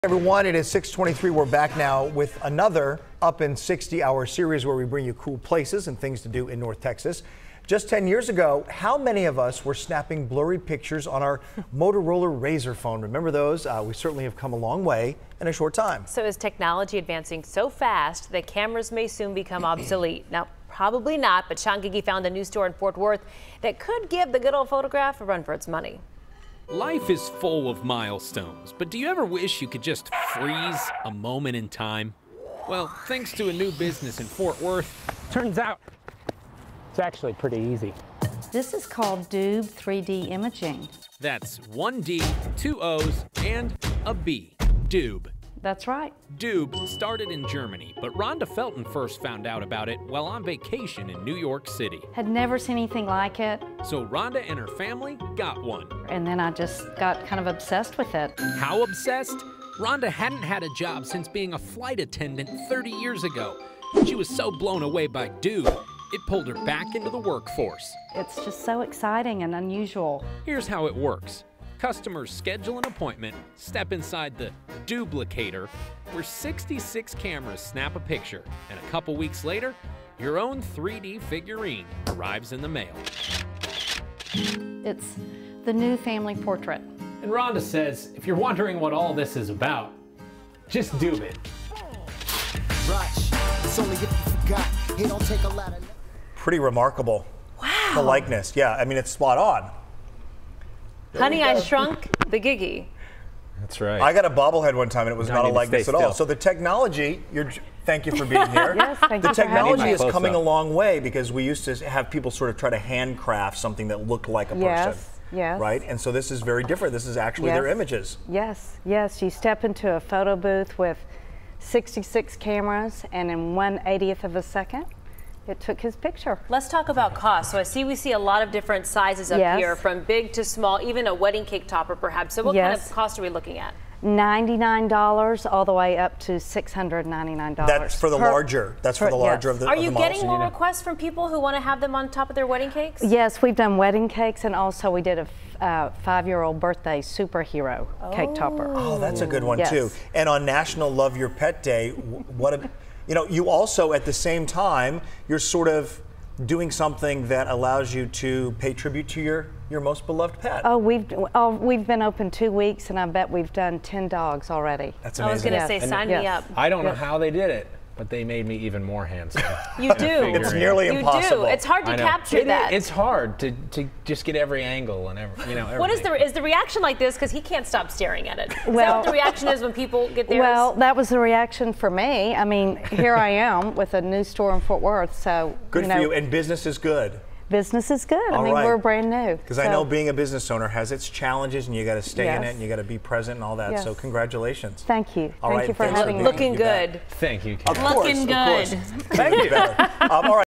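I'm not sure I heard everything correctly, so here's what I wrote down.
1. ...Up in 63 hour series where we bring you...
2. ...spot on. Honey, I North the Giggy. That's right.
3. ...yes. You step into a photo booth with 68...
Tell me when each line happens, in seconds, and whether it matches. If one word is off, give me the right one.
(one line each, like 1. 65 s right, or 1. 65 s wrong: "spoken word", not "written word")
1. 3 s wrong: "60", not "63"
2. 99 s wrong: "Shrunk", not "North"
3. 118 s wrong: "66", not "68".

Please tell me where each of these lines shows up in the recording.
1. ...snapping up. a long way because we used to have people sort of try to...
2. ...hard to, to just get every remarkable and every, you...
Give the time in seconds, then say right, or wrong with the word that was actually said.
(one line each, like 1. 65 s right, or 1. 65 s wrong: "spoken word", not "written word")
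1. 110 s wrong: "coming", not "snapping"
2. 172 s wrong: "angle", not "remarkable".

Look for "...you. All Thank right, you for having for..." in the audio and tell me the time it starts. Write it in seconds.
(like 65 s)
195 s.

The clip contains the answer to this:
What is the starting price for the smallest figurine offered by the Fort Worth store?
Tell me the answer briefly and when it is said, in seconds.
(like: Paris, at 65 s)
$99, at 134 s.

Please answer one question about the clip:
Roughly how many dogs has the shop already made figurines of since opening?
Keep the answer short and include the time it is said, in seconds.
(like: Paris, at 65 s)
10, at 163 s.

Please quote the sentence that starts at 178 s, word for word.
Well, the reaction is when people get there.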